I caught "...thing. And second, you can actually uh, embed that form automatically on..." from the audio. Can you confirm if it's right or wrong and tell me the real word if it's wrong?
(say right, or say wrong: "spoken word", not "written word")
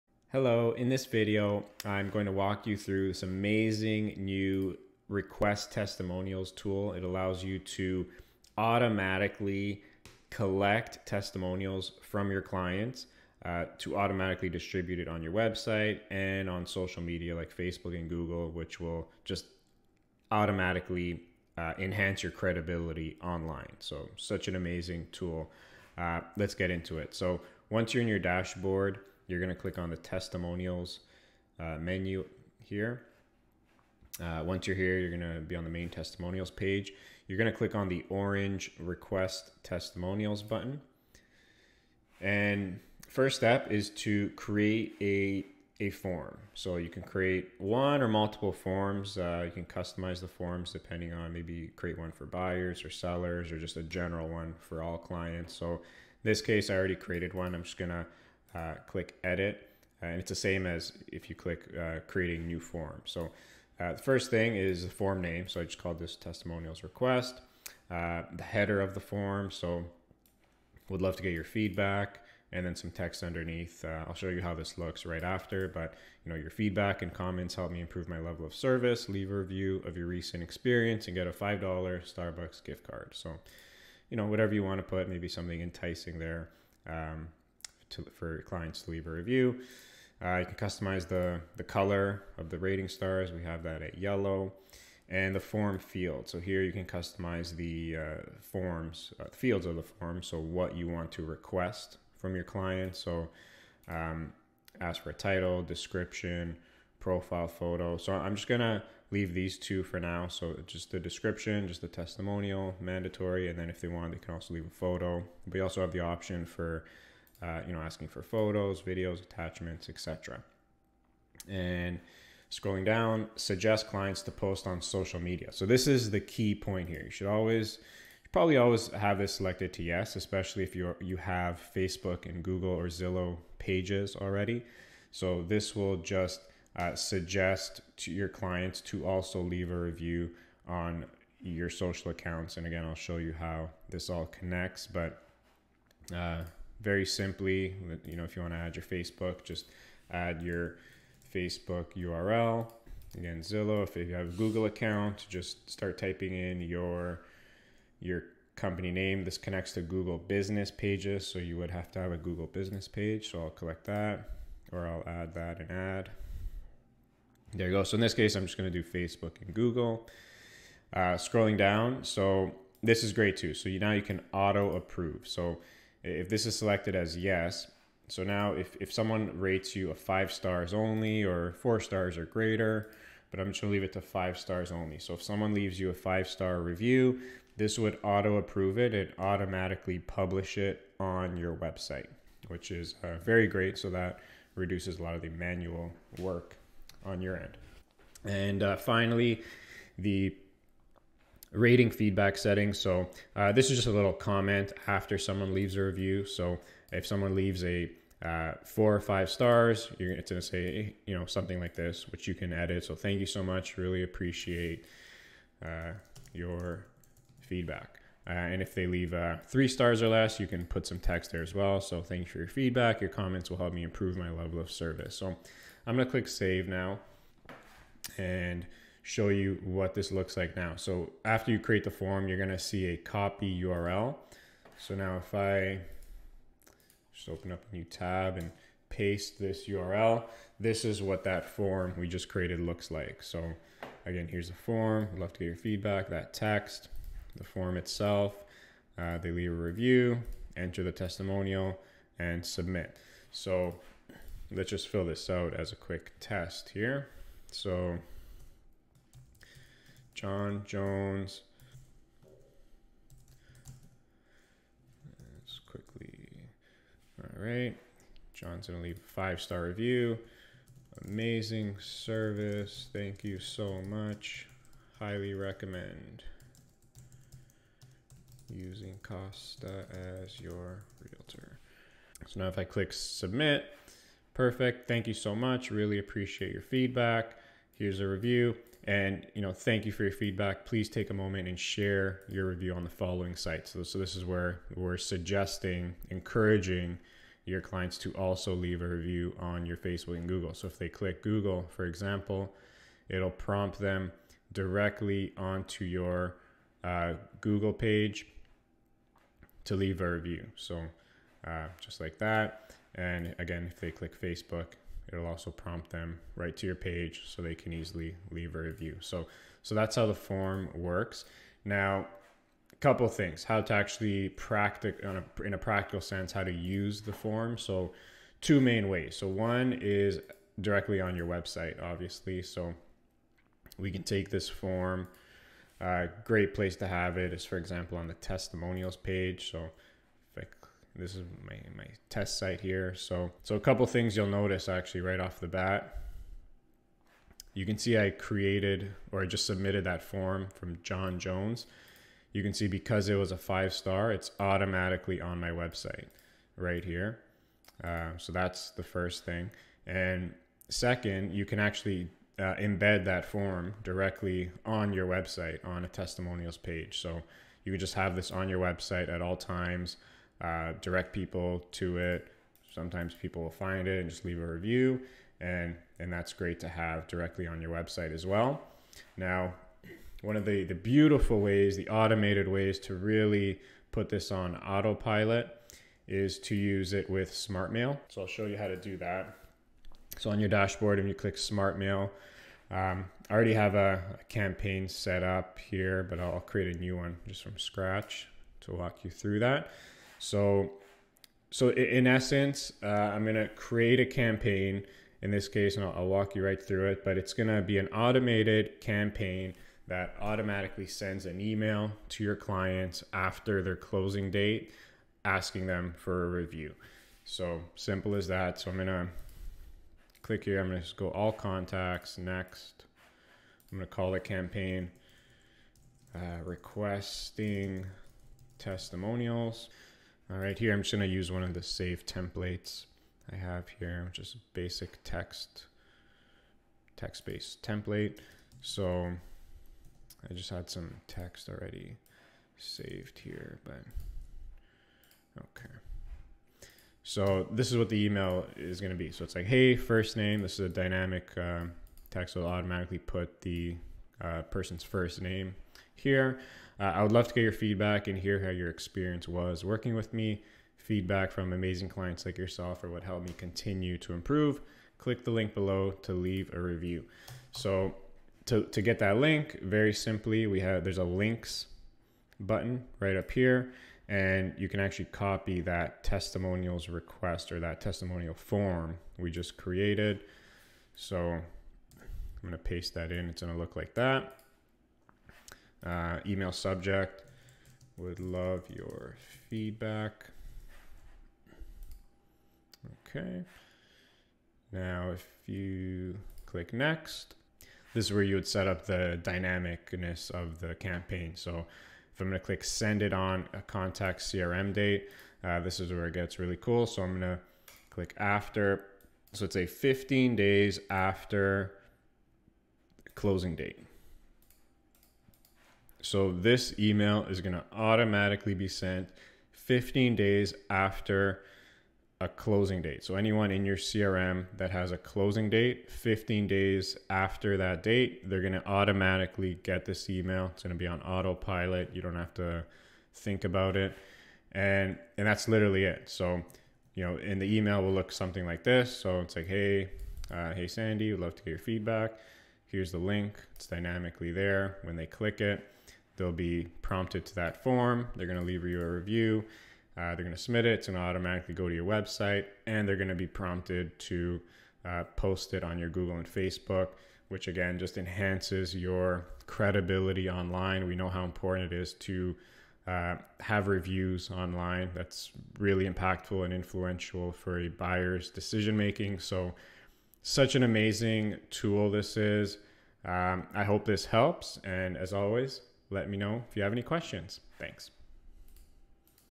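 wrong: "directly", not "automatically".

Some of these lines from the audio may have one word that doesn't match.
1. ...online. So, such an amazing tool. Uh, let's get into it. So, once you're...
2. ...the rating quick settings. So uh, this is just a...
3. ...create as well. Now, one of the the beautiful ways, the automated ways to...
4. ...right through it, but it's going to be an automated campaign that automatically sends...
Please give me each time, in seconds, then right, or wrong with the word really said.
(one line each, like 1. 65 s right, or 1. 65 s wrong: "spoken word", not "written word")
1. 23 s right
2. 199 s wrong: "feedback", not "quick"
3. 377 s wrong: "website", not "create"
4. 406 s right.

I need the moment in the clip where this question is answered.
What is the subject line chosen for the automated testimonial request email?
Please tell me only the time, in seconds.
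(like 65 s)
487 s.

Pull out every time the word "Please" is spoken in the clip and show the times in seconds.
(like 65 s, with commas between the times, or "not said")
290 s.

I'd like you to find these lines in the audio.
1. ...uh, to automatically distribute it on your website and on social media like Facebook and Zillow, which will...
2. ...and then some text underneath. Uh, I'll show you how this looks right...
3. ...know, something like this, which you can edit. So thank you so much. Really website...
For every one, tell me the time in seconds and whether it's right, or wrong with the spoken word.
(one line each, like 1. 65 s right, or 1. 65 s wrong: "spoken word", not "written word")
1. 13 s wrong: "Google", not "Zillow"
2. 72 s right
3. 211 s wrong: "appreciate", not "website".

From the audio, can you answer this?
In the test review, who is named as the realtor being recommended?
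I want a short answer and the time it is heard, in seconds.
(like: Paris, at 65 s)
Costa, at 279 s.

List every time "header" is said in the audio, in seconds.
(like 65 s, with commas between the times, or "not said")
68 s.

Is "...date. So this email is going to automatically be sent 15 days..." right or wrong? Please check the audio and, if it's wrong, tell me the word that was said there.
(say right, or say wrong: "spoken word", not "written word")
right.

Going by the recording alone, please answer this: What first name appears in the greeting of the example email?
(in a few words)
Sandy.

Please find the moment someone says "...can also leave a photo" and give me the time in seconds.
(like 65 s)
114 s.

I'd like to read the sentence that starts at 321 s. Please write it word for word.
Now, a couple things, how to actually practice in a practical sense, how to use the form.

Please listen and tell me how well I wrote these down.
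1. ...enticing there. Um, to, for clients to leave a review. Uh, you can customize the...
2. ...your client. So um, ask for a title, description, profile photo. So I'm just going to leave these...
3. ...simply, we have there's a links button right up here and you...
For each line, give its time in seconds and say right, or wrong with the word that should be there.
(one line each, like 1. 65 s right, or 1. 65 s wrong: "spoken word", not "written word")
1. 85 s right
2. 102 s right
3. 469 s right.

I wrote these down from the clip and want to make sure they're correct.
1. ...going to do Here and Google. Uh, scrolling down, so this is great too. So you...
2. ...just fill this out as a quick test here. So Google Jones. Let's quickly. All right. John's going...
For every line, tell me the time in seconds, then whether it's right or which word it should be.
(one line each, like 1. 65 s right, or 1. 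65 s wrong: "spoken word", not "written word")
1. 168 s wrong: "Facebook", not "Here"
2. 254 s wrong: "John", not "Google".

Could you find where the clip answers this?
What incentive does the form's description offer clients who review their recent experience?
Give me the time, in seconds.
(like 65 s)
81 s.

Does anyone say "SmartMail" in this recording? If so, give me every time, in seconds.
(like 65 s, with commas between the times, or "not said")
387 s, 391 s.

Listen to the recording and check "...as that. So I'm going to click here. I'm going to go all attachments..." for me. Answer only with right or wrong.
wrong.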